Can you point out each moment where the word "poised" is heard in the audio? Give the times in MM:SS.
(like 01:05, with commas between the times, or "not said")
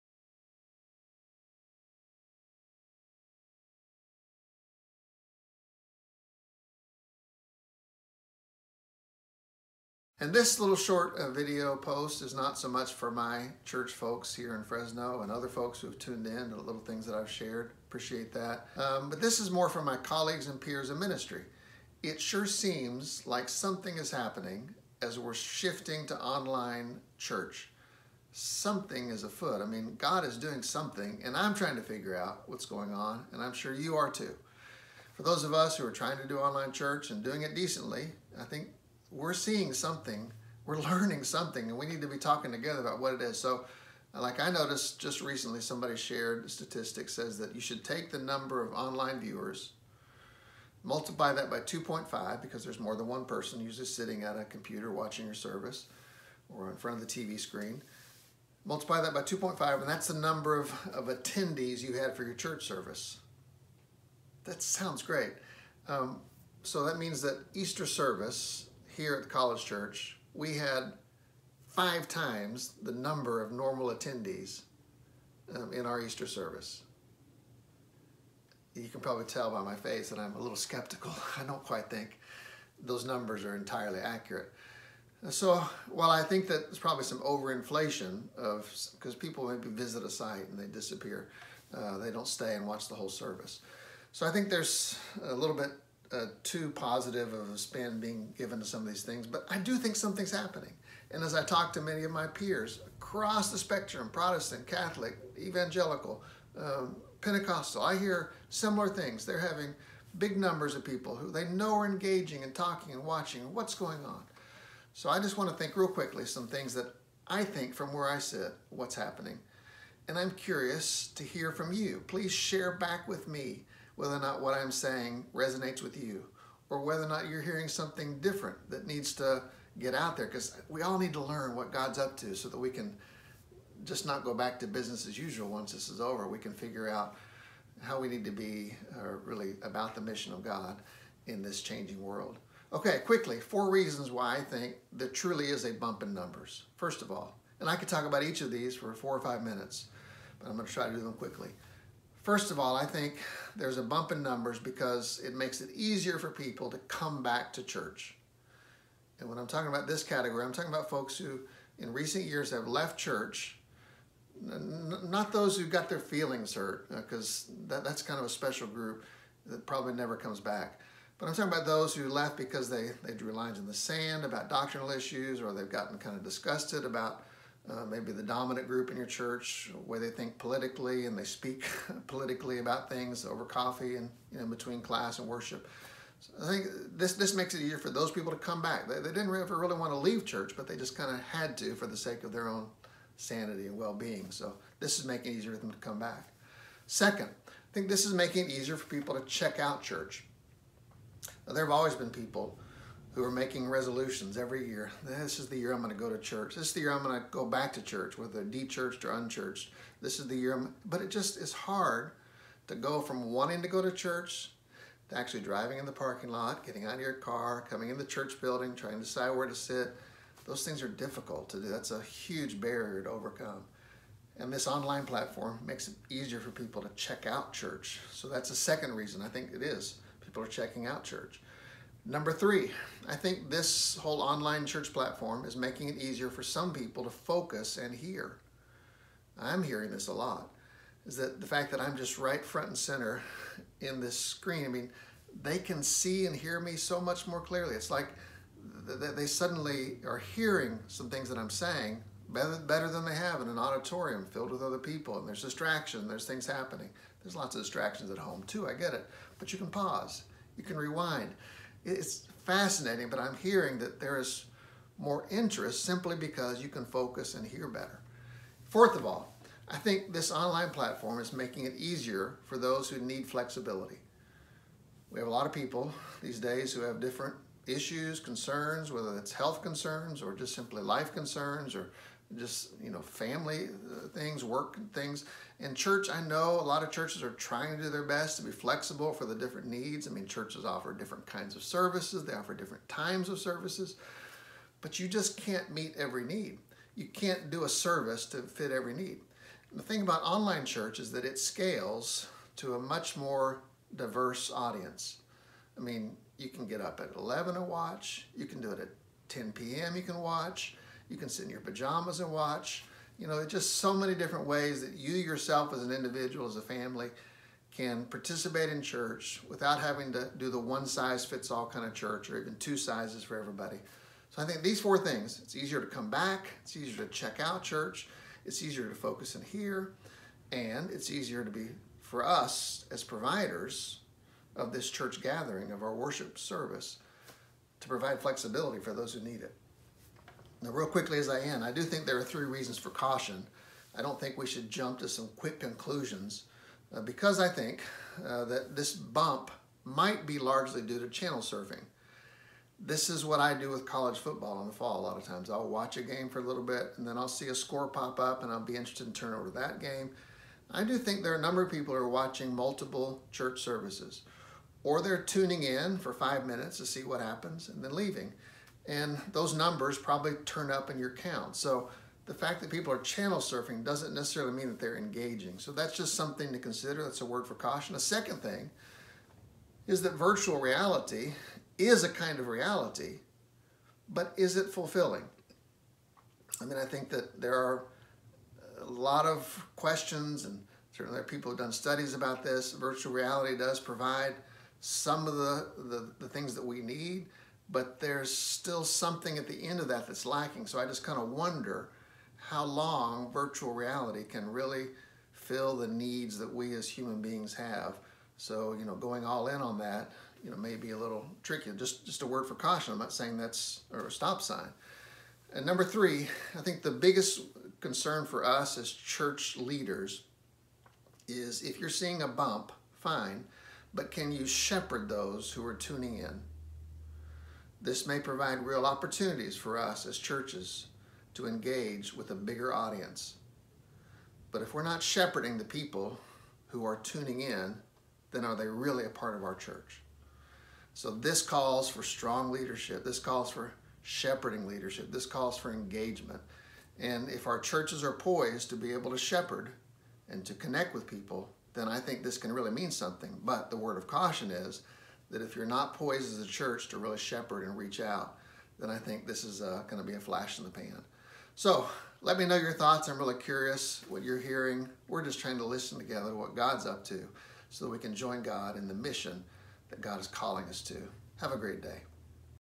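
07:28, 07:35.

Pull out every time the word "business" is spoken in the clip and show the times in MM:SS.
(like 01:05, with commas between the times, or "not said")
02:14.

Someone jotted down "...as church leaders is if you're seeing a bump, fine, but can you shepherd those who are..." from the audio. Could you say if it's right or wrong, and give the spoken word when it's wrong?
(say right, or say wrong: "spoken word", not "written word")
right.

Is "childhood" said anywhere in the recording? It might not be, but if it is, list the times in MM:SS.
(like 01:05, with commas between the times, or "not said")
not said.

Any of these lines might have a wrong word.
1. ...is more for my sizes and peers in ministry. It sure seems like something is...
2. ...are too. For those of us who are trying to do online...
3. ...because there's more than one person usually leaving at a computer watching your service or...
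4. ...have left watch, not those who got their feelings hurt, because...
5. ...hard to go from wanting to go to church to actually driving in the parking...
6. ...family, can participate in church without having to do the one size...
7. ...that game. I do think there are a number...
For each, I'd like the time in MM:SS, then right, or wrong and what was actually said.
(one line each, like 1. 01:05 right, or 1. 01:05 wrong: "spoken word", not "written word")
1. 00:19 wrong: "colleagues", not "sizes"
2. 00:33 right
3. 00:52 wrong: "sitting", not "leaving"
4. 02:42 wrong: "church", not "watch"
5. 03:31 right
6. 05:16 right
7. 05:59 right.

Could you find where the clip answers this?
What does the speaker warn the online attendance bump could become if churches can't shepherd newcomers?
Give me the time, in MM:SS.
07:40.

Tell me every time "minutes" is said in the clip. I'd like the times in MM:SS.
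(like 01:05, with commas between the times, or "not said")
02:29, 06:06.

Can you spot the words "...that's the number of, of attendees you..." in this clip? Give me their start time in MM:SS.
00:59.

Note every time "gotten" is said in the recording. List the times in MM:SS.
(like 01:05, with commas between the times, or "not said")
02:55.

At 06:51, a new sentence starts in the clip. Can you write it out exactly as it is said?
Just, just a word for caution.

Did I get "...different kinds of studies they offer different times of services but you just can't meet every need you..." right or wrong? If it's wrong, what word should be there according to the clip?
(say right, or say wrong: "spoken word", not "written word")
wrong: "services", not "studies".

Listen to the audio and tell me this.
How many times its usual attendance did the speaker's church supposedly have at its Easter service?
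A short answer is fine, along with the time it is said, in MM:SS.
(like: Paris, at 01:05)
5 times, at 01:11.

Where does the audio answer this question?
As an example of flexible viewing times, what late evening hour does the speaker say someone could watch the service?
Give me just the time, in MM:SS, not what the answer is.
05:09.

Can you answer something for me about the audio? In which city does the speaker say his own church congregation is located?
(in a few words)
Fresno.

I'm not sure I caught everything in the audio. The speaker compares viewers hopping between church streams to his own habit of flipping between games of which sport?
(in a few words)
College football.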